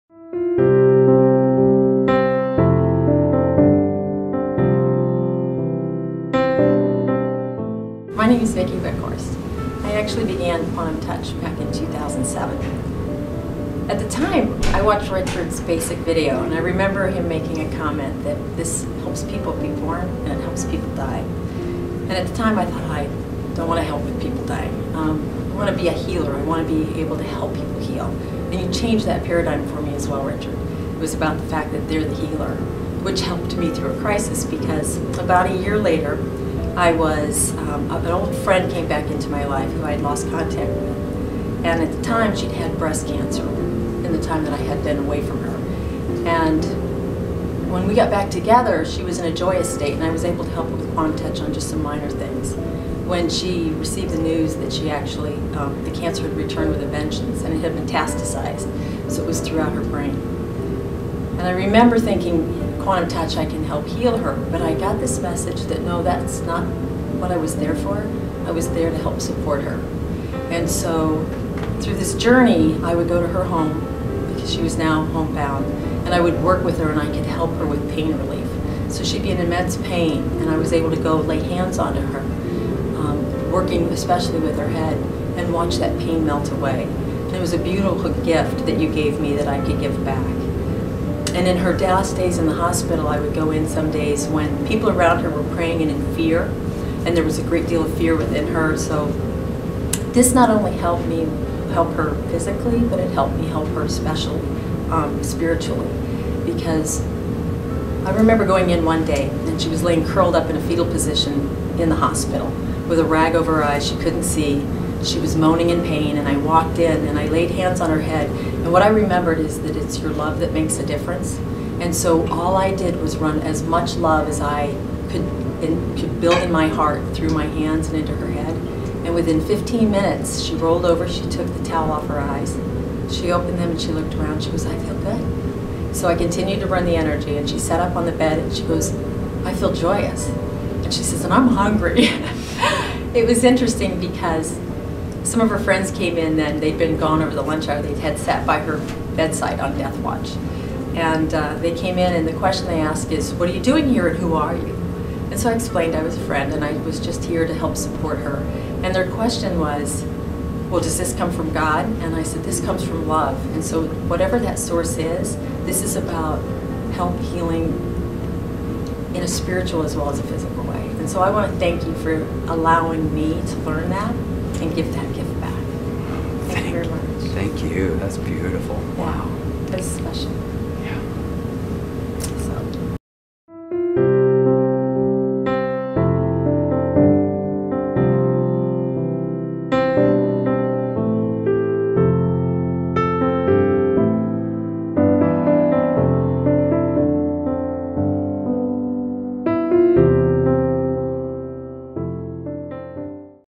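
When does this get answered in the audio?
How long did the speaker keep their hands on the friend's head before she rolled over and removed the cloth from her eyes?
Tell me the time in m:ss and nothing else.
2:09.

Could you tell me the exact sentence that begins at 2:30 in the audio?
And uh, they came in and the question they asked is, what are you doing here and who are you?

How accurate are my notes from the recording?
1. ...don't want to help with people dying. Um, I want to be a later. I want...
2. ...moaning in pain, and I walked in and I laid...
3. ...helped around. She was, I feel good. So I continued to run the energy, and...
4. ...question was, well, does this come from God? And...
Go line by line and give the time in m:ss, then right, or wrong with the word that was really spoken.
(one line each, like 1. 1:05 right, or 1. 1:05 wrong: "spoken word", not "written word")
1. 0:23 wrong: "healer", not "later"
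2. 1:55 right
3. 2:13 wrong: "looked", not "helped"
4. 2:39 right.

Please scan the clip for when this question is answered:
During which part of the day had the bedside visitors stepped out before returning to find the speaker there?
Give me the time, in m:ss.
2:27.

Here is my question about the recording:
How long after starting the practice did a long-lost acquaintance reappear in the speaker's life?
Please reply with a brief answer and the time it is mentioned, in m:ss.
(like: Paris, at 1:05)
about a year, at 0:35.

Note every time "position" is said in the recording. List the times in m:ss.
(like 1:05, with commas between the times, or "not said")
1:50.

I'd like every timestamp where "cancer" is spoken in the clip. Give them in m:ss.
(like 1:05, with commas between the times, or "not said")
0:43, 0:55.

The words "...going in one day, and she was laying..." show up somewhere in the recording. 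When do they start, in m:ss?
1:48.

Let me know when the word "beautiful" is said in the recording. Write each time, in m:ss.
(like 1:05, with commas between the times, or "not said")
1:27, 2:58.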